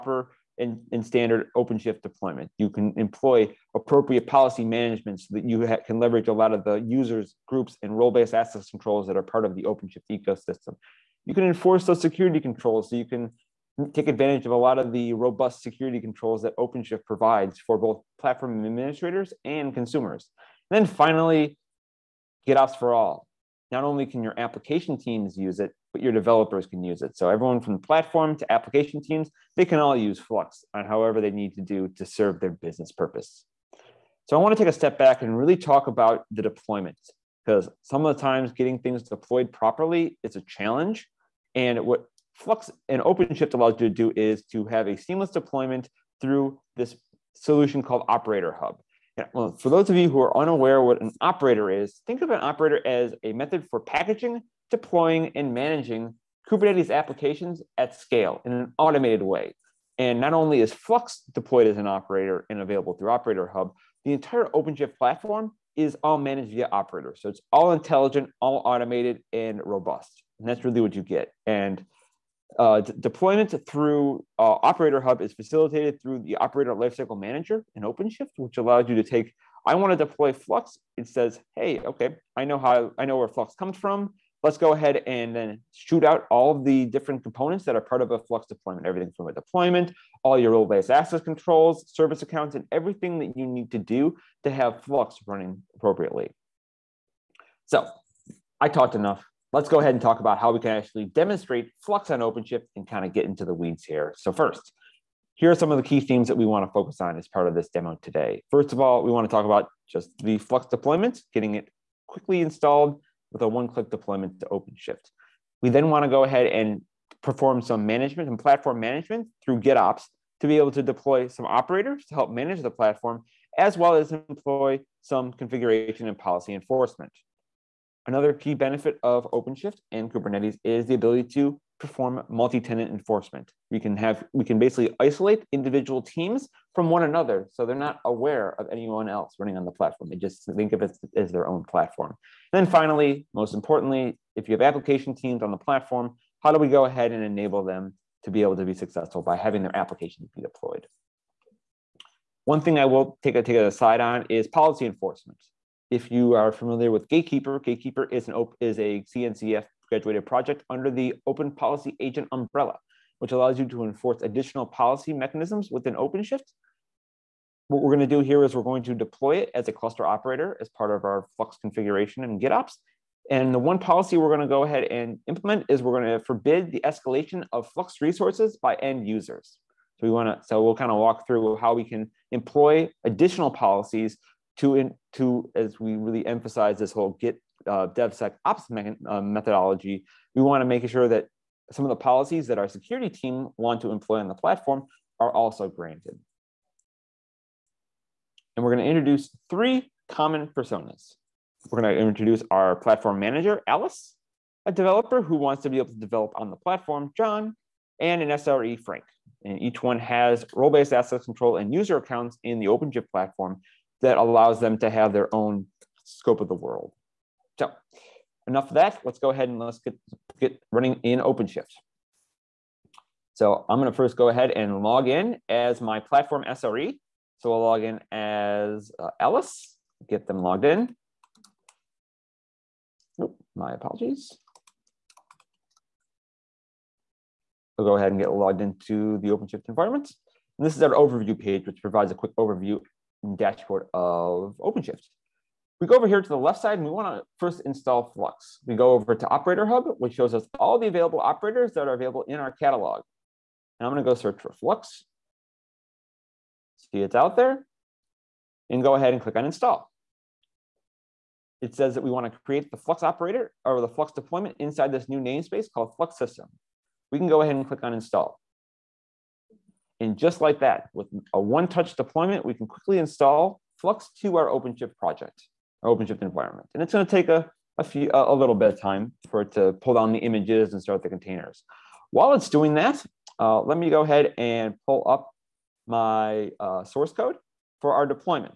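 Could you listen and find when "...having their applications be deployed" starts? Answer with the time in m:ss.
2:29.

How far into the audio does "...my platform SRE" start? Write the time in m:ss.
3:45.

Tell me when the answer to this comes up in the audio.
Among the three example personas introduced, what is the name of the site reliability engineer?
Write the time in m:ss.
3:28.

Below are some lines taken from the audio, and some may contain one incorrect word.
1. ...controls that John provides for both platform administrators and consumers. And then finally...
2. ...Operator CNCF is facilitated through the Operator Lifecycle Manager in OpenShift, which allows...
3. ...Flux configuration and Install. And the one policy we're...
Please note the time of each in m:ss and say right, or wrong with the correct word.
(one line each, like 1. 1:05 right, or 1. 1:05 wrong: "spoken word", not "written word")
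1. 0:15 wrong: "OpenShift", not "John"
2. 1:14 wrong: "Hub", not "CNCF"
3. 2:51 wrong: "GitOps", not "Install".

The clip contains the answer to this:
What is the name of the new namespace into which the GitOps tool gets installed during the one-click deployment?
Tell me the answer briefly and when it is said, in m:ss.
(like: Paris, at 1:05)
Flux System, at 4:25.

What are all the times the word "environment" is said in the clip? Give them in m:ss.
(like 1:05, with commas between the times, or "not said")
3:59, 4:36.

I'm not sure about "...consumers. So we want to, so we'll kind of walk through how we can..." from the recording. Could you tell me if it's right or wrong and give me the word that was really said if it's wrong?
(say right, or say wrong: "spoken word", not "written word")
wrong: "users", not "consumers".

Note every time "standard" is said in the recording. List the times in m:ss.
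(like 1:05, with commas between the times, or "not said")
0:01.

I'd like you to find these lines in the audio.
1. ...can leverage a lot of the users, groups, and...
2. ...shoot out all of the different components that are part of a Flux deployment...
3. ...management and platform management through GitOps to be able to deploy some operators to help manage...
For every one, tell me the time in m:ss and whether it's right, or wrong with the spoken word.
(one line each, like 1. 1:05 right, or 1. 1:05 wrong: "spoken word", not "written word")
1. 0:05 right
2. 1:25 right
3. 1:57 right.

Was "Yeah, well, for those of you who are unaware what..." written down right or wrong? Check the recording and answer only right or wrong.
right.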